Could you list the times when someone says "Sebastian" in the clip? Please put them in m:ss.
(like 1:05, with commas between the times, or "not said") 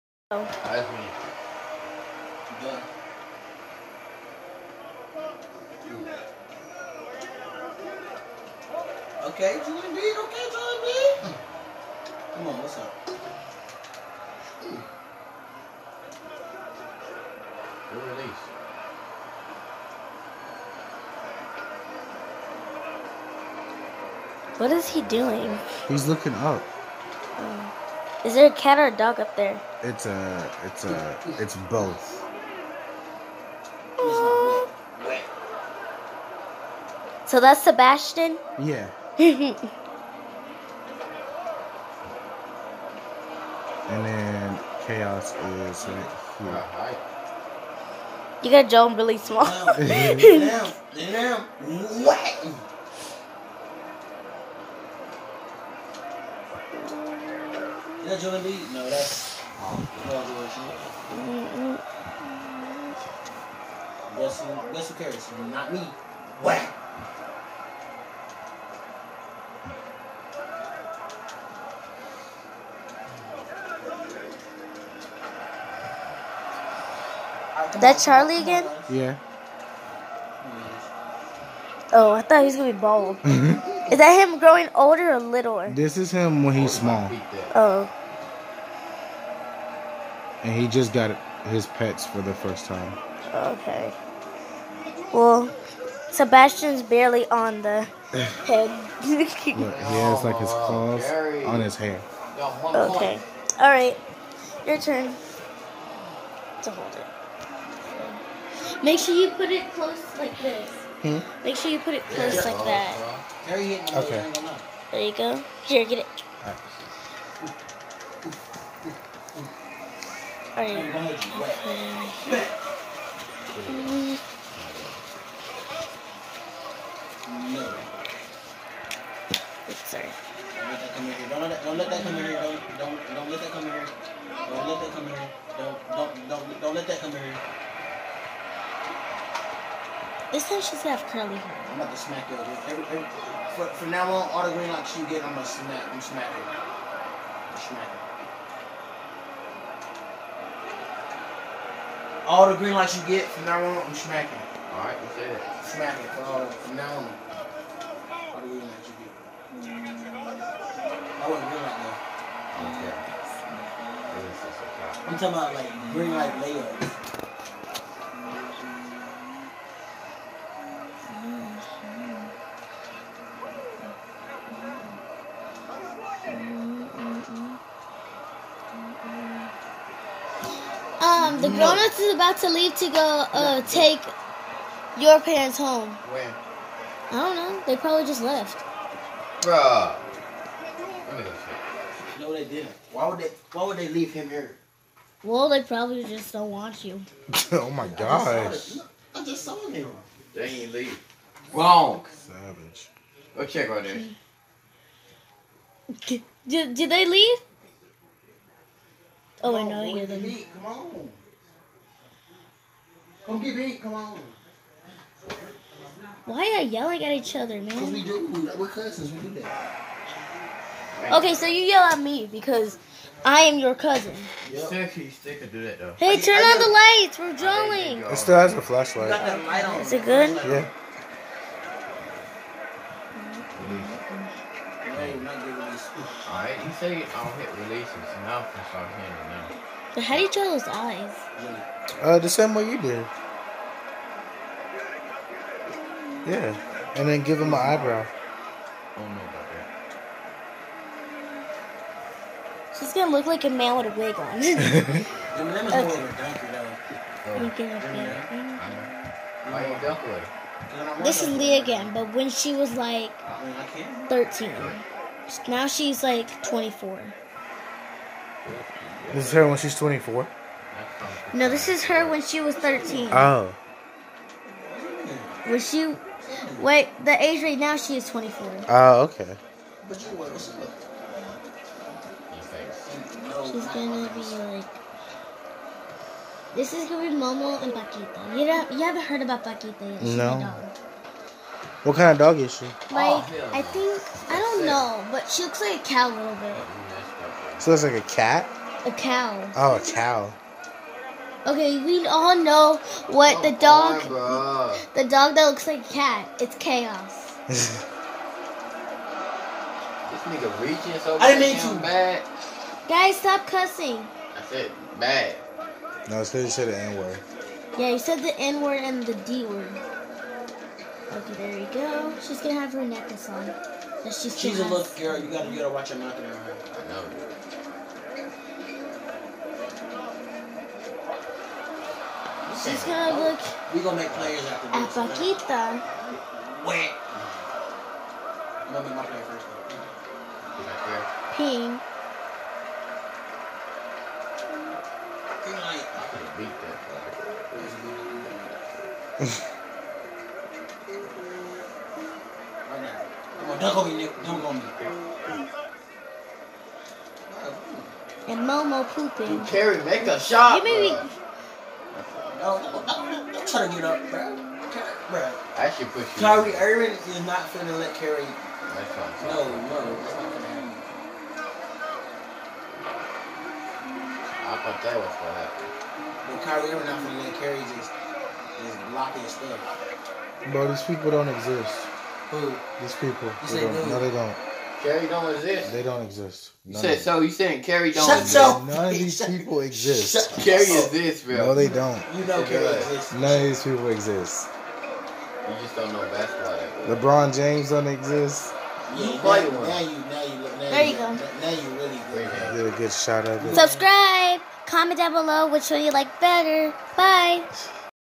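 0:37, 1:36.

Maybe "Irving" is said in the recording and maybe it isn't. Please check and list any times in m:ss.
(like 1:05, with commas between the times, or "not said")
6:06, 6:16.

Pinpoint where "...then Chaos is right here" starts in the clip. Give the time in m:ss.
0:44.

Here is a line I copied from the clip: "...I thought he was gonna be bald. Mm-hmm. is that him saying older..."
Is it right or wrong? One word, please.
wrong.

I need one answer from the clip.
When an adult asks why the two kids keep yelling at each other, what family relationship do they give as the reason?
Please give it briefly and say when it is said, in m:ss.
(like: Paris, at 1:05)
Cousins, at 3:38.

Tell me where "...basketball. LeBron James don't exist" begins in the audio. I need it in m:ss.
6:36.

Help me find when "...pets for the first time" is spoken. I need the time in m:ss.
1:31.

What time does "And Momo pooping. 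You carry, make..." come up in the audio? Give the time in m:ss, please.
5:58.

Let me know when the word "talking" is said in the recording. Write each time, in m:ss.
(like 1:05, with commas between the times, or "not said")
2:45.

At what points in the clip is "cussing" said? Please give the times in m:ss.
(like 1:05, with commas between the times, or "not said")
5:13.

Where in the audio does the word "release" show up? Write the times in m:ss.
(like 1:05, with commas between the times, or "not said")
0:18, 3:57.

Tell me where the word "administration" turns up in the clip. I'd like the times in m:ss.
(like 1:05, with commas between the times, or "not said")
not said.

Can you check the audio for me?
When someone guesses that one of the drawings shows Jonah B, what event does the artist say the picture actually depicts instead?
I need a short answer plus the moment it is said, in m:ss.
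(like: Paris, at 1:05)
Graduation, at 1:00.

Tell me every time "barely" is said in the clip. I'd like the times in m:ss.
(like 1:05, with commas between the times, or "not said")
1:36.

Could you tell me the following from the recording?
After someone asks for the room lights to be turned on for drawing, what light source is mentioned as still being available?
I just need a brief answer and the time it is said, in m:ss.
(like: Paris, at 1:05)
A flashlight, at 3:48.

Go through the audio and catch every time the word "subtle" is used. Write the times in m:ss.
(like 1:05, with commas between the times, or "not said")
not said.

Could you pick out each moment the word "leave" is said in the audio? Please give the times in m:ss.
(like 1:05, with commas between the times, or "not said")
3:02, 3:13, 3:20, 3:27.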